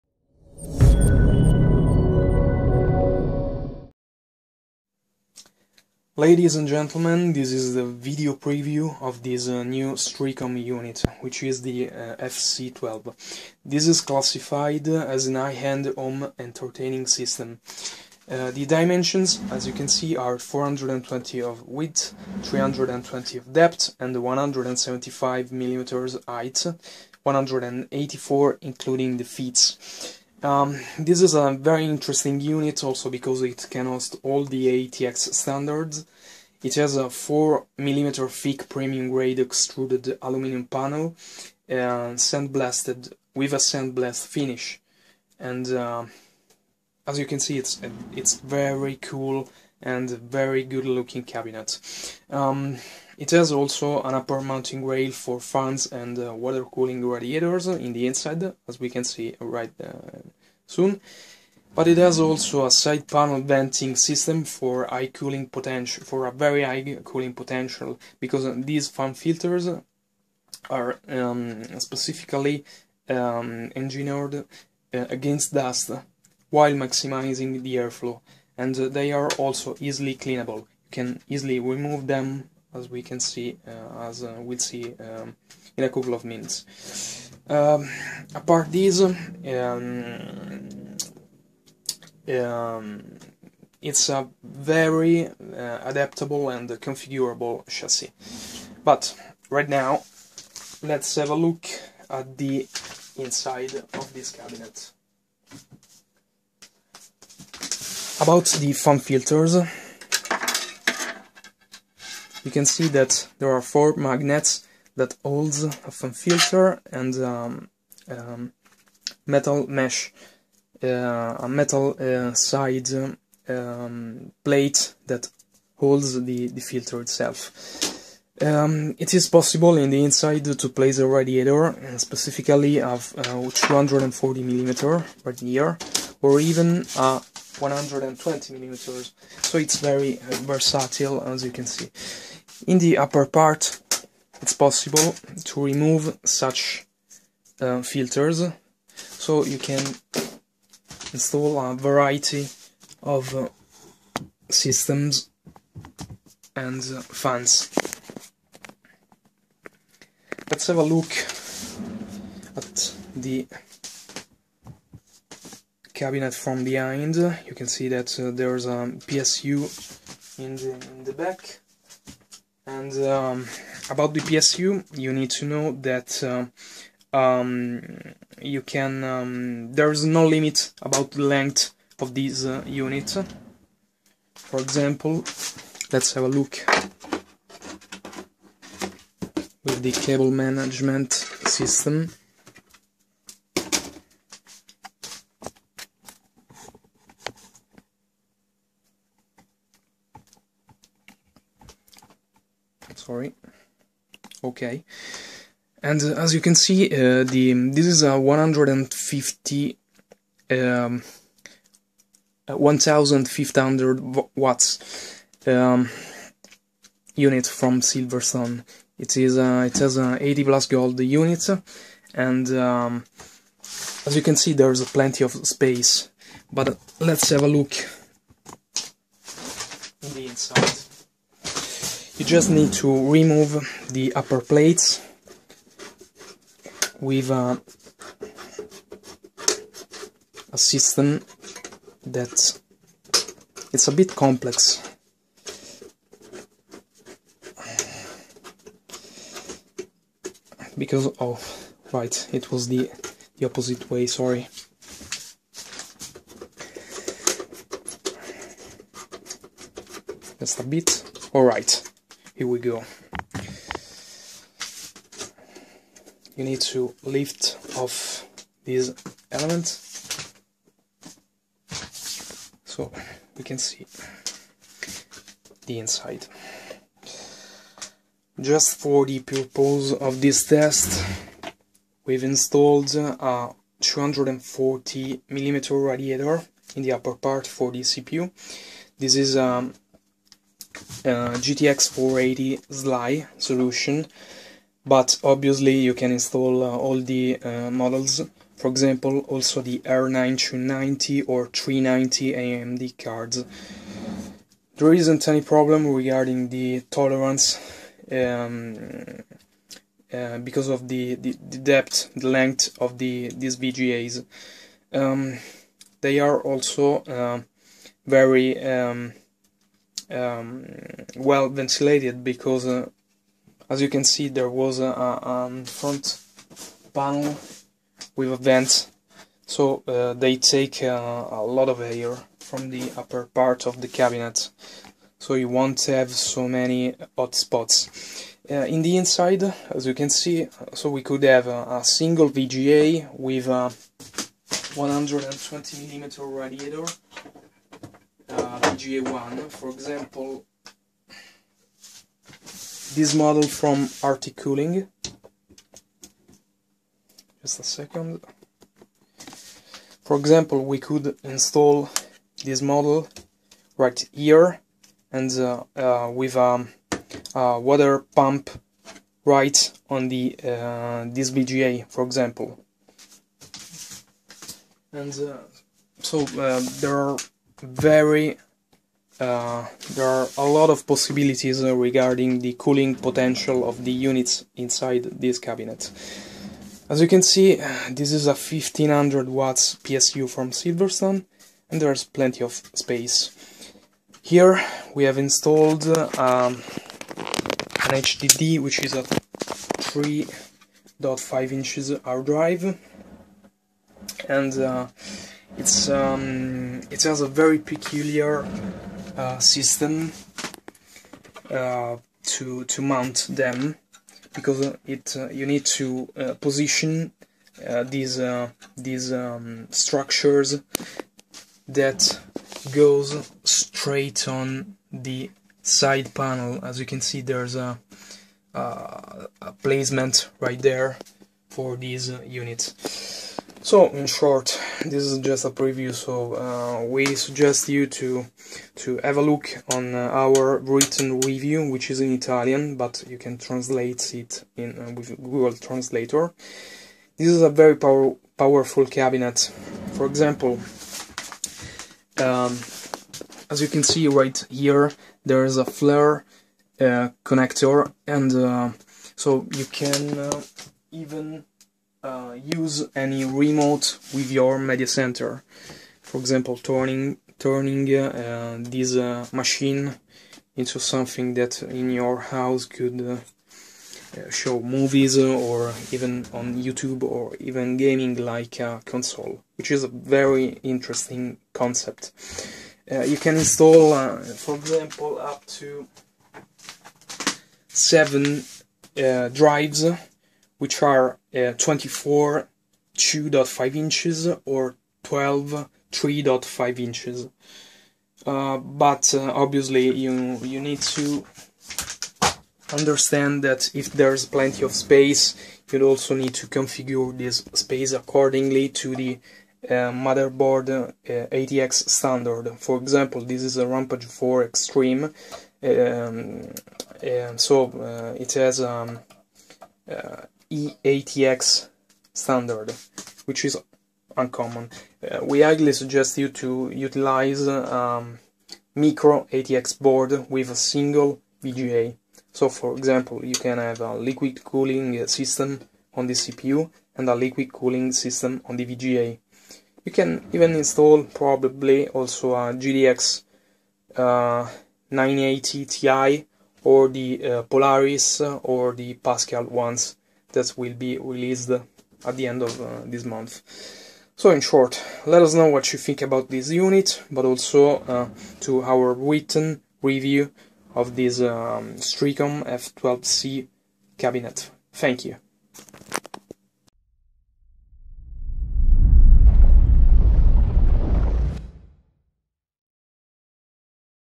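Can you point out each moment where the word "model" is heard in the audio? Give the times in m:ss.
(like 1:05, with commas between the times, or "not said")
4:57, 5:53, 6:02.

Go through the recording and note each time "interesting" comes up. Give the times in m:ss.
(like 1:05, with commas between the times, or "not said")
0:31, 8:00.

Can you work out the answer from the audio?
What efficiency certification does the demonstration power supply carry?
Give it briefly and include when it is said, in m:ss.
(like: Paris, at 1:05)
80 Plus Gold, at 3:40.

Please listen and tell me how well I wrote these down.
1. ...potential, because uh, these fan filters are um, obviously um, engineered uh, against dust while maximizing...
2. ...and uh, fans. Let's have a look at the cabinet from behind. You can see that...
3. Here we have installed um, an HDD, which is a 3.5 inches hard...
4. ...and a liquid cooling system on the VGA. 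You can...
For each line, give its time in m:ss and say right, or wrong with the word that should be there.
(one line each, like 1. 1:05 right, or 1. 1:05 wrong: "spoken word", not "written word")
1. 1:07 wrong: "specifically", not "obviously"
2. 2:36 right
3. 6:34 right
4. 8:56 right.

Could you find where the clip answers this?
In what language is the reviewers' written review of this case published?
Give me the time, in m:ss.
7:22.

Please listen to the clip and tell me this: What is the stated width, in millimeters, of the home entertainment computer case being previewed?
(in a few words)
420.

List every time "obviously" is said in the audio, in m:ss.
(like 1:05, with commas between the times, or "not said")
4:55, 8:19.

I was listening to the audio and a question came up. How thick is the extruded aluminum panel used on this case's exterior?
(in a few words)
4mm.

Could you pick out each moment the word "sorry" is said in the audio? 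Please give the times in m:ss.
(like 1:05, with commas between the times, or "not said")
3:22, 4:14.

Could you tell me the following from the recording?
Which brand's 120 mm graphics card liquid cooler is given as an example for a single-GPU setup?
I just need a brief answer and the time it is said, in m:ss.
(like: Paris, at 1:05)
Arctic Cooling, at 5:54.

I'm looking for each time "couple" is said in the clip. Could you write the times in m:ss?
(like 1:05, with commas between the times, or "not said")
1:25.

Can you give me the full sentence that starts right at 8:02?
Uh, you can install, uh, for example, up to seven drives which are uh, 24 2.5 inches or 12 3.5 inches.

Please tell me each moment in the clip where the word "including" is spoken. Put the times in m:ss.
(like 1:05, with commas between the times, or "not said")
0:28.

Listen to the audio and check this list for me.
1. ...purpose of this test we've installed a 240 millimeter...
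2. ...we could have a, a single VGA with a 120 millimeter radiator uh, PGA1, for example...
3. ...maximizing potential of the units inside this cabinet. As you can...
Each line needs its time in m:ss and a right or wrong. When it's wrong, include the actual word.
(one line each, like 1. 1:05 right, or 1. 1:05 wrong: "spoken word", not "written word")
1. 4:39 right
2. 5:40 right
3. 6:22 wrong: "cooling", not "maximizing".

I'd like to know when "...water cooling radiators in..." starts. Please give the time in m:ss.
0:56.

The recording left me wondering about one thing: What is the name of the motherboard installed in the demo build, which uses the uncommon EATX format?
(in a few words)
Rampage 4 Extreme.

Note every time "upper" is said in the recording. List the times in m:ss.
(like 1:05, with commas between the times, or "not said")
0:54, 2:22, 3:54, 4:46, 5:32.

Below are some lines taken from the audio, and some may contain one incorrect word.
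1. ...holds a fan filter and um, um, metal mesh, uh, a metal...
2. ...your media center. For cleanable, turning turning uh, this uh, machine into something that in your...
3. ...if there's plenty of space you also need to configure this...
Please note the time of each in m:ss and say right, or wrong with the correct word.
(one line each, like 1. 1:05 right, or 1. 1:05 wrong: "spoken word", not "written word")
1. 1:55 right
2. 7:44 wrong: "example", not "cleanable"
3. 8:23 right.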